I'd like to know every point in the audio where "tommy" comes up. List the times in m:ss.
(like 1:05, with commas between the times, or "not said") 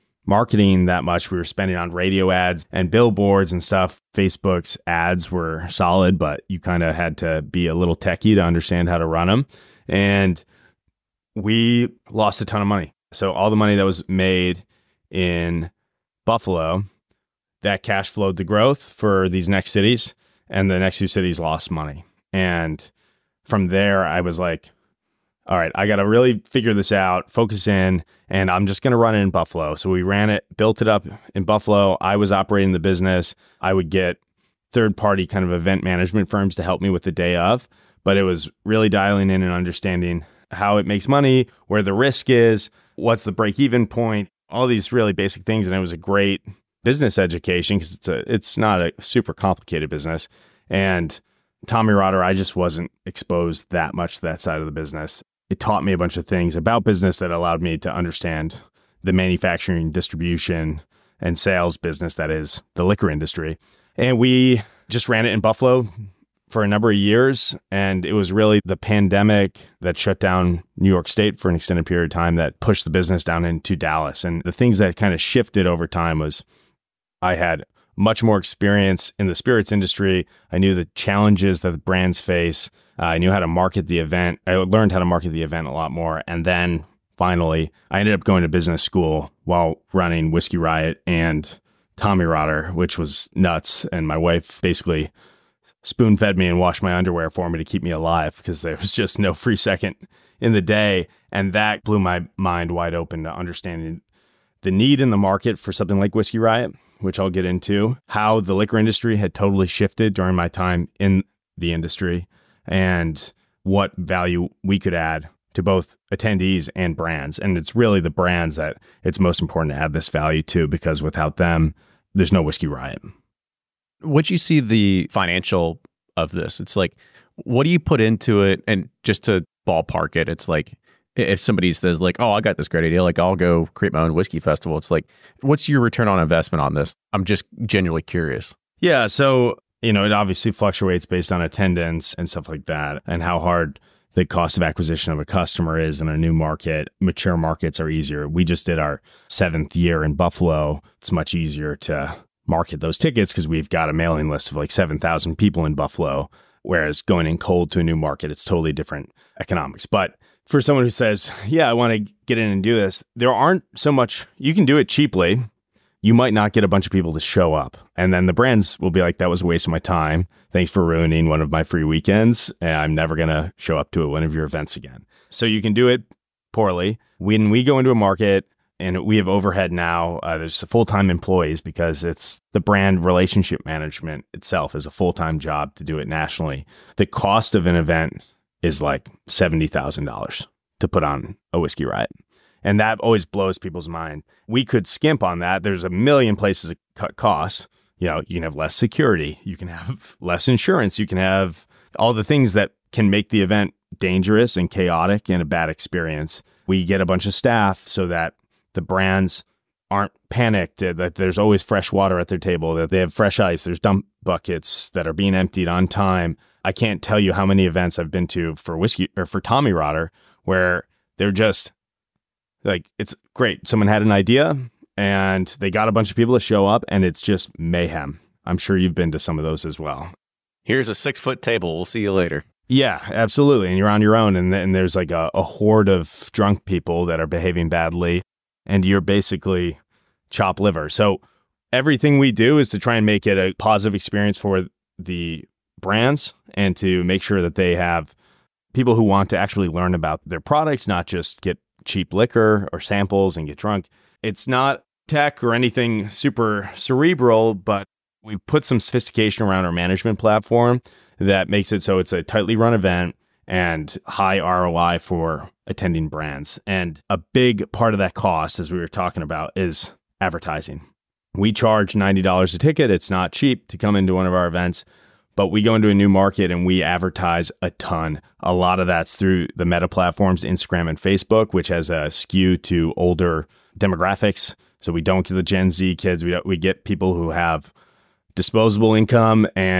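0:51, 1:31, 3:39.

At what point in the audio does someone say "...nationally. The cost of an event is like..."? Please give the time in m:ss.
3:06.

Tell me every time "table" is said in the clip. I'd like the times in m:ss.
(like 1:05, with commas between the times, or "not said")
3:32, 3:51.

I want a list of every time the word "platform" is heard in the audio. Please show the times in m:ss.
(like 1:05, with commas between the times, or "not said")
4:20, 4:39.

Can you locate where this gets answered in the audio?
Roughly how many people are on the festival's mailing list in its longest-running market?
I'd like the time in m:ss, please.
2:34.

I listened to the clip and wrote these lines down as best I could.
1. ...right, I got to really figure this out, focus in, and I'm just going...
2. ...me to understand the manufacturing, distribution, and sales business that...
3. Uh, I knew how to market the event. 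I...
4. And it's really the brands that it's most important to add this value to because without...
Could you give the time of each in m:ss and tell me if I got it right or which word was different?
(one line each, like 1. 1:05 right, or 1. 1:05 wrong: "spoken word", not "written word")
1. 0:25 right
2. 0:57 right
3. 1:22 right
4. 1:57 right.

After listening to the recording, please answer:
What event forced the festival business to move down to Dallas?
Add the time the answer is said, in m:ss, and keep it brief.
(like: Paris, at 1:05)
The pandemic, at 1:08.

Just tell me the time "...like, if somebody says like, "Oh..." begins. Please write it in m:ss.
2:10.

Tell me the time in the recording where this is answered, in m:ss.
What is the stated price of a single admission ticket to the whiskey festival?
4:31.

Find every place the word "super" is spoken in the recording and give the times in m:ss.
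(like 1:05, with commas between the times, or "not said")
0:48, 4:16.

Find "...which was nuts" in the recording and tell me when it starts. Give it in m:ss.
1:32.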